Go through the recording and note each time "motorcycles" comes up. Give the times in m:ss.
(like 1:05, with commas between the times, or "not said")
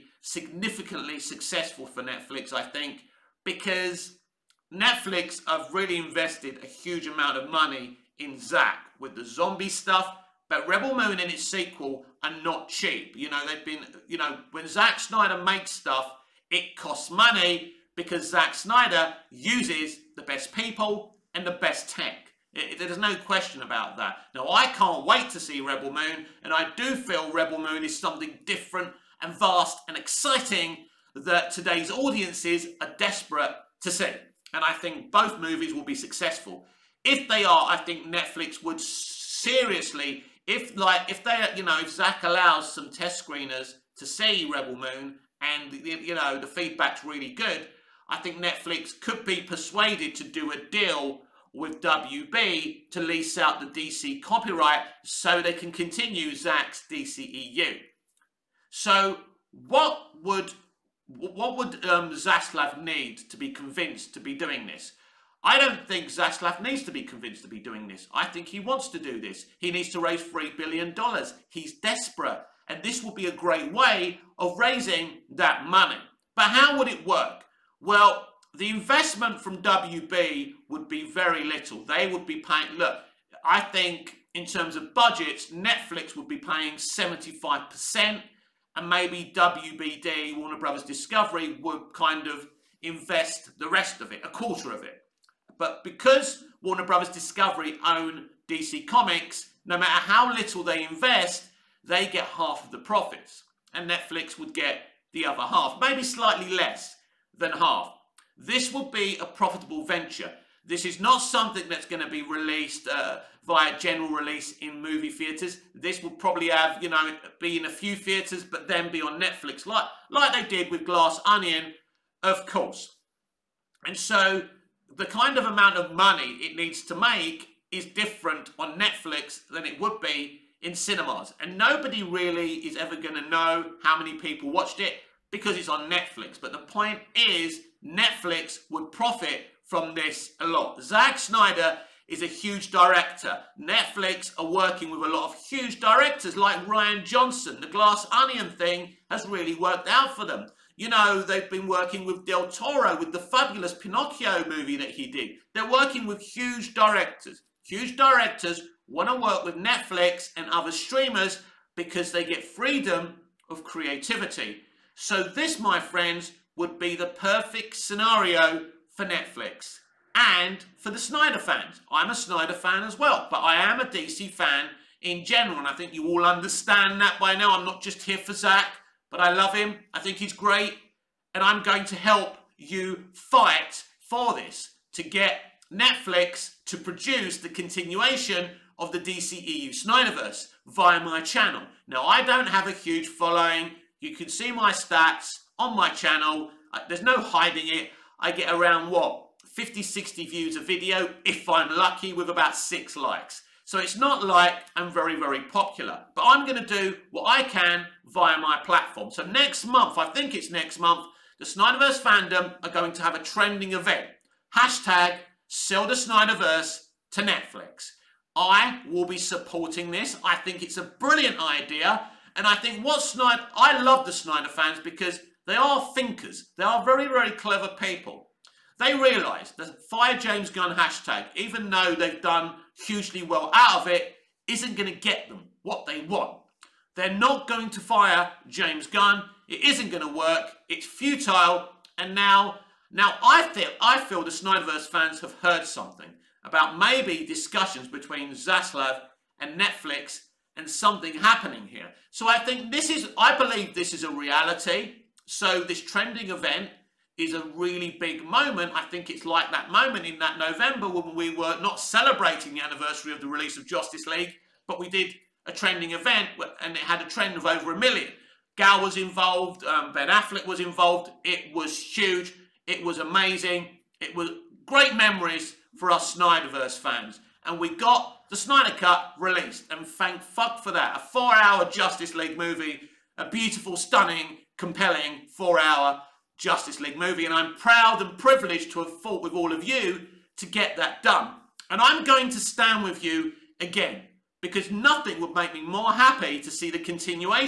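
not said.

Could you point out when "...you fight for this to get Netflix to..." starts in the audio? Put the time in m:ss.
3:02.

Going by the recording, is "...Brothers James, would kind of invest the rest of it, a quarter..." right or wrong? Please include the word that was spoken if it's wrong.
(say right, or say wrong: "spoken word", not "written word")
wrong: "Discovery", not "James".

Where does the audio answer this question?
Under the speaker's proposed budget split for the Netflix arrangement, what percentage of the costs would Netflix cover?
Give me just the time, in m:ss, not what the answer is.
1:26.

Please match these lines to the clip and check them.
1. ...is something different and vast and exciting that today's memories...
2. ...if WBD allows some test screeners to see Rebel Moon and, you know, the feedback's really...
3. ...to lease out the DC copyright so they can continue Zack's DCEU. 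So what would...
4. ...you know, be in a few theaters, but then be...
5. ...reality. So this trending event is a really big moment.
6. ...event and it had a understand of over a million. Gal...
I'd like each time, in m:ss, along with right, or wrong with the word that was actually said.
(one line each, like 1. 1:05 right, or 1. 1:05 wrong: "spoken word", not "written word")
1. 0:27 wrong: "audiences", not "memories"
2. 0:41 wrong: "Zack", not "WBD"
3. 0:52 right
4. 1:56 right
5. 4:14 right
6. 4:25 wrong: "trend", not "understand".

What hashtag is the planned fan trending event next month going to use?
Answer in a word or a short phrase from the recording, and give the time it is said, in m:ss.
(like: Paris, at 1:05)
Sell the Snyderverse to Netflix, at 3:35.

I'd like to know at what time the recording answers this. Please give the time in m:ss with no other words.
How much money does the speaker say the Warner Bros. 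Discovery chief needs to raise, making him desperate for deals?
1:10.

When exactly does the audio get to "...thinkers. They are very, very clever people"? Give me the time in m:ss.
3:45.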